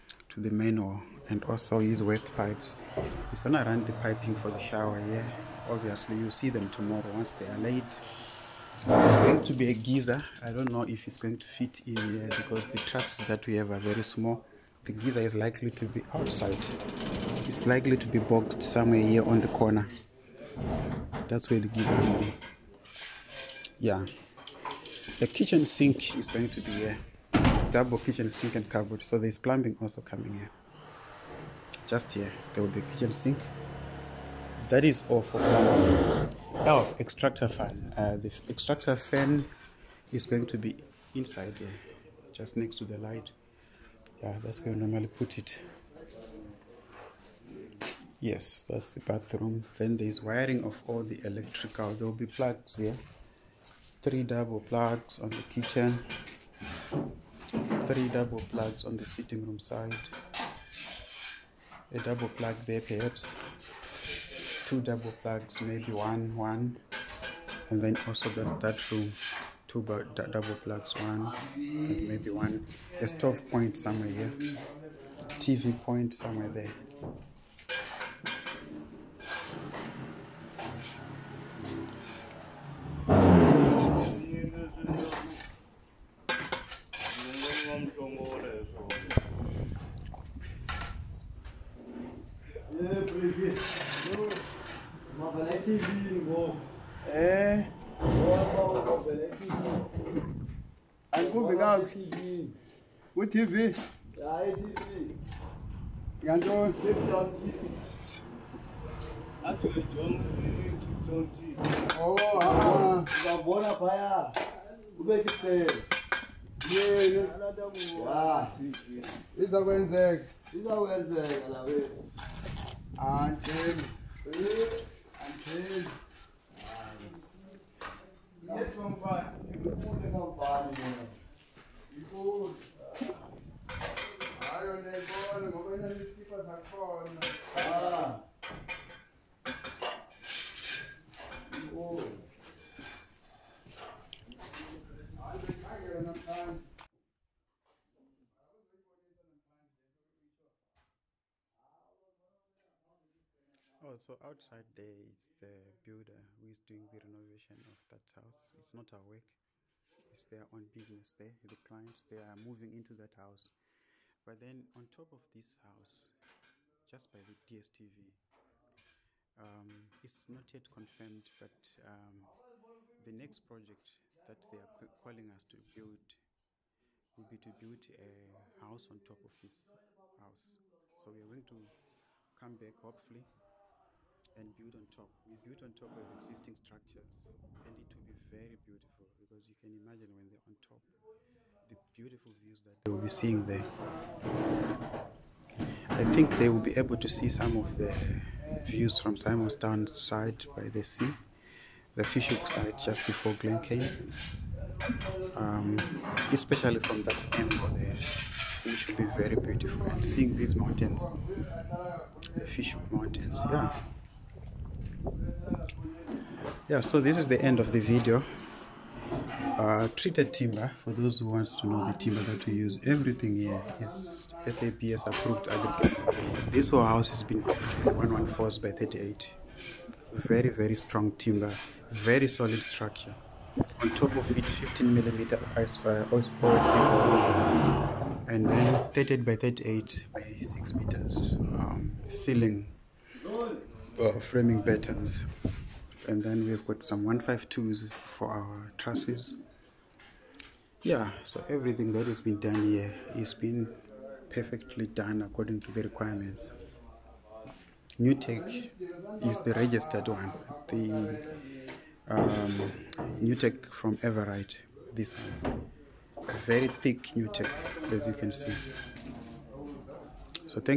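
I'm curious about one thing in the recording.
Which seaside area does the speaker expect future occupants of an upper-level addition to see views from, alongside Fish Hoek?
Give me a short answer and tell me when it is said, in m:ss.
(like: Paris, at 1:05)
Simonstown, at 3:19.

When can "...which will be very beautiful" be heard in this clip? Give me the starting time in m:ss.
3:28.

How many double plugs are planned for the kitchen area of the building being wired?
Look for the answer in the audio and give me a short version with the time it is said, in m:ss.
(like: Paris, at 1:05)
3, at 0:54.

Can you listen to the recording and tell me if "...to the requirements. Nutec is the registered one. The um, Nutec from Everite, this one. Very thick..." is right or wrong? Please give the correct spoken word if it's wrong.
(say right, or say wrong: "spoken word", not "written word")
right.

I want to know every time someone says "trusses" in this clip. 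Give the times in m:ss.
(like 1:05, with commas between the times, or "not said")
0:12, 4:08.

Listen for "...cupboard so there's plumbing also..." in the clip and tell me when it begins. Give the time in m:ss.
0:28.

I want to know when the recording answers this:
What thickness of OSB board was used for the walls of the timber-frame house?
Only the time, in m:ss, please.
3:54.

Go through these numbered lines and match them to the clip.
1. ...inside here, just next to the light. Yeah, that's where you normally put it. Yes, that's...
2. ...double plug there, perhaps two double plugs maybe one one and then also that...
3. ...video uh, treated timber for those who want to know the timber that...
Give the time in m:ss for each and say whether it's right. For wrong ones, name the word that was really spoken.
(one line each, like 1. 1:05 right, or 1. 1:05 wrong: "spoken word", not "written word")
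1. 0:41 right
2. 1:01 right
3. 3:37 right.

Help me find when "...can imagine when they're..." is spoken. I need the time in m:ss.
3:09.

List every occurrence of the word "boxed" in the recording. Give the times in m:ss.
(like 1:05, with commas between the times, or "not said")
0:18.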